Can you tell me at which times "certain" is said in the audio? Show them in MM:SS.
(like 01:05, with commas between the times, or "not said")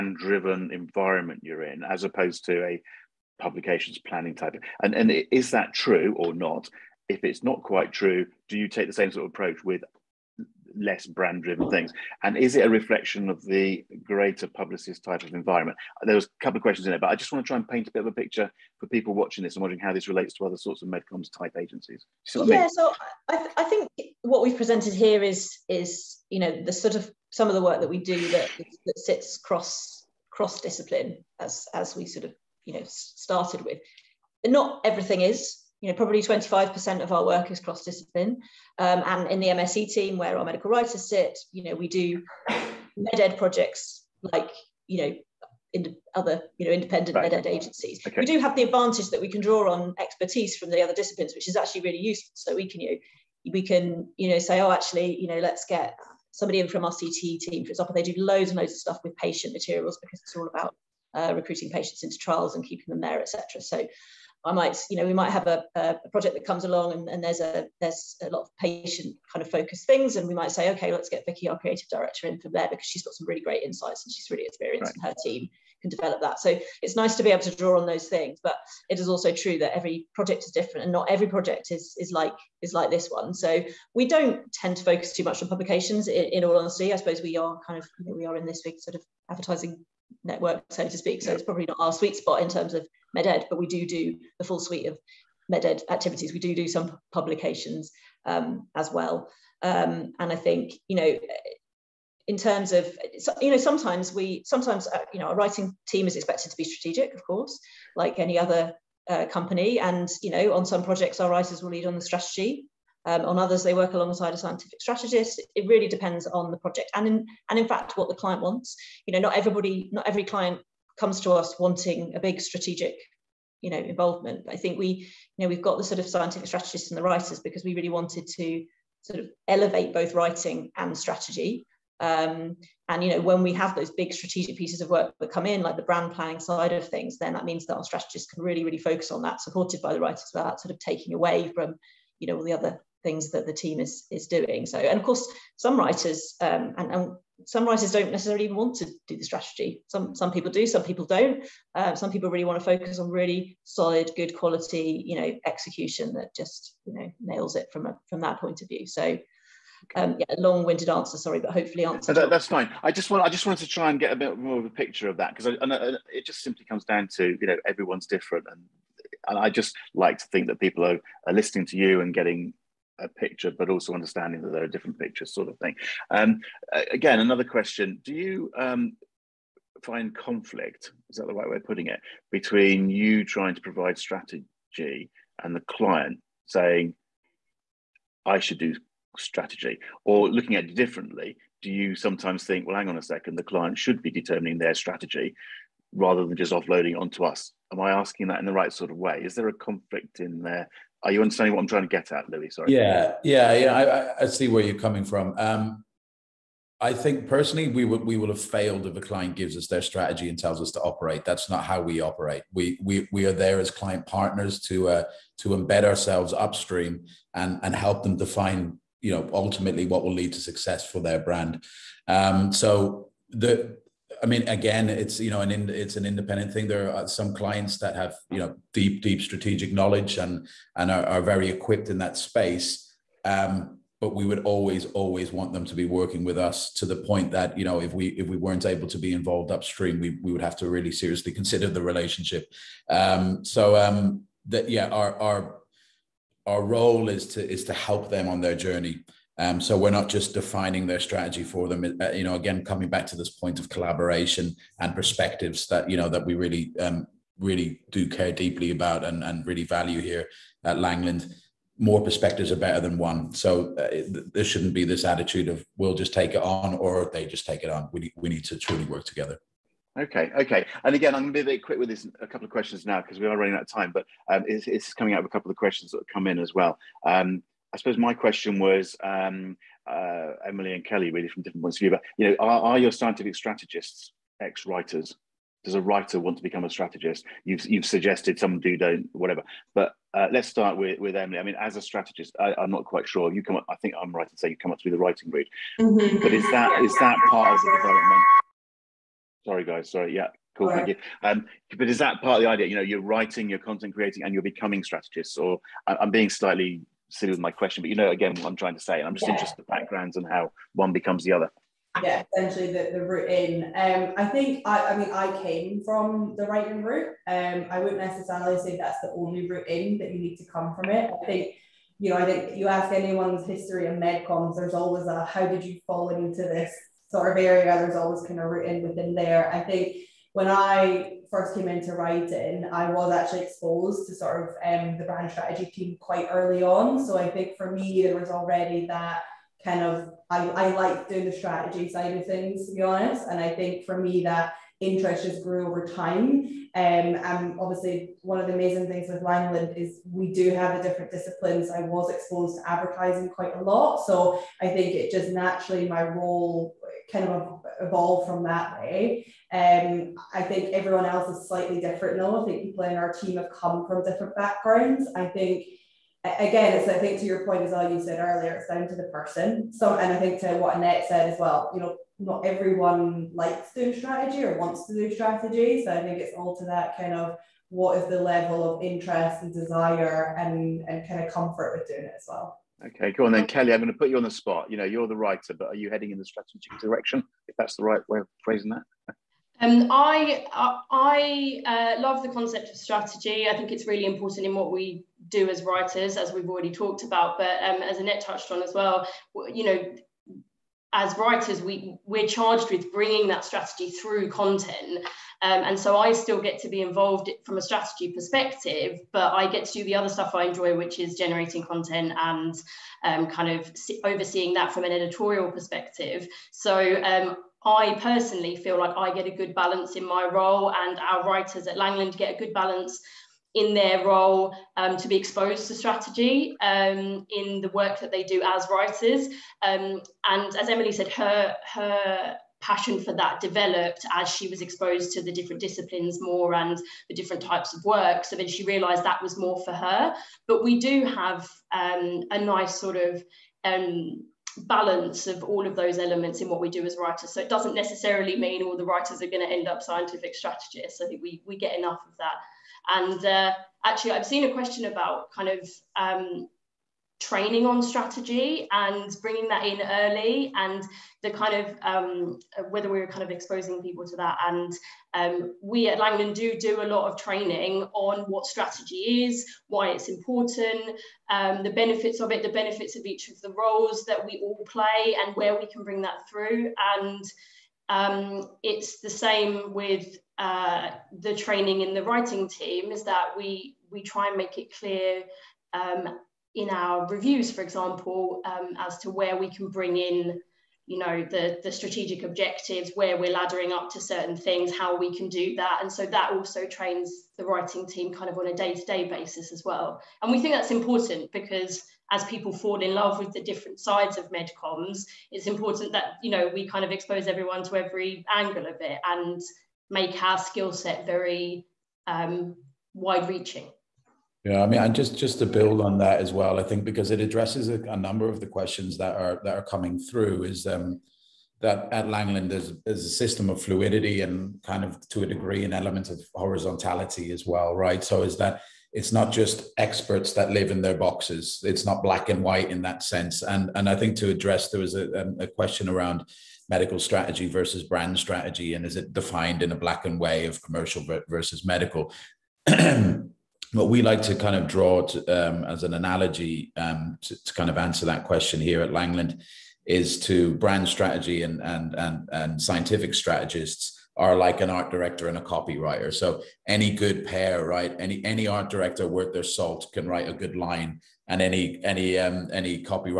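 08:14.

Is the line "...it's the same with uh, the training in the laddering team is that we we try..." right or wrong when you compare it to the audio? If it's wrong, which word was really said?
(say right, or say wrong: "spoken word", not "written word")
wrong: "writing", not "laddering".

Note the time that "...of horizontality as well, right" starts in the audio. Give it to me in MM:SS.
08:46.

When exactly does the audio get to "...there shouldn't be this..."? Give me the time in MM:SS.
04:24.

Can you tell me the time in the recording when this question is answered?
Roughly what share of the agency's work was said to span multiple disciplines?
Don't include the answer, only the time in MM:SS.
00:36.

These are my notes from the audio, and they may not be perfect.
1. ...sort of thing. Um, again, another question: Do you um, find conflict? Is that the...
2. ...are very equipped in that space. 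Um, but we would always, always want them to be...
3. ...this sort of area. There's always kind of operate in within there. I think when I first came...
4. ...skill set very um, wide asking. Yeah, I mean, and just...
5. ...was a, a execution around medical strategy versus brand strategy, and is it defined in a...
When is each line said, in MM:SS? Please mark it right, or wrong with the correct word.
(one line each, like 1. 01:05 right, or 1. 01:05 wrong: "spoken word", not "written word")
1. 02:55 right
2. 03:51 right
3. 05:26 wrong: "route", not "operate"
4. 08:30 wrong: "reaching", not "asking"
5. 08:54 wrong: "question", not "execution".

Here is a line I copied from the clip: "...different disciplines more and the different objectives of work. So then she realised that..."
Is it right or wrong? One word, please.
wrong.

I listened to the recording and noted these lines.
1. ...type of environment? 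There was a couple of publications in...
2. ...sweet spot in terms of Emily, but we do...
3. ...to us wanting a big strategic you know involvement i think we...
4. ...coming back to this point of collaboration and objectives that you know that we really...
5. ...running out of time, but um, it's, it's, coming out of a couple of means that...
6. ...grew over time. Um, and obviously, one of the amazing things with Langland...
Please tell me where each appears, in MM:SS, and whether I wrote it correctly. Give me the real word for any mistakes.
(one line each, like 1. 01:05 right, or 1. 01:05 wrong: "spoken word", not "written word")
1. 00:15 wrong: "questions", not "publications"
2. 01:31 wrong: "MedEd", not "Emily"
3. 02:01 right
4. 04:12 wrong: "perspectives", not "objectives"
5. 04:33 wrong: "questions", not "means"
6. 05:45 right.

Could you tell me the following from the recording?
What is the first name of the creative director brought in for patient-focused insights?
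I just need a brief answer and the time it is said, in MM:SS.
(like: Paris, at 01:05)
Vicky, at 01:11.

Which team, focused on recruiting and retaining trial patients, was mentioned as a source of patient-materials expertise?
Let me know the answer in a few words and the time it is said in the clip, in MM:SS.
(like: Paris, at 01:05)
CTE team, at 00:56.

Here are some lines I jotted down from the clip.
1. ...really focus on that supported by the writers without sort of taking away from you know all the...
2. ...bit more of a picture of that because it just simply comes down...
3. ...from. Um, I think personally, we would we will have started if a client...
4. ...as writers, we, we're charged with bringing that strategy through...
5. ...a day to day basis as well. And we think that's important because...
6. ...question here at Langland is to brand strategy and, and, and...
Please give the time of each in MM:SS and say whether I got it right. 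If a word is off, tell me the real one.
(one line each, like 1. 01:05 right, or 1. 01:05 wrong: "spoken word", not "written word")
1. 02:18 right
2. 02:44 right
3. 03:25 wrong: "failed", not "started"
4. 06:40 right
5. 08:18 right
6. 09:08 right.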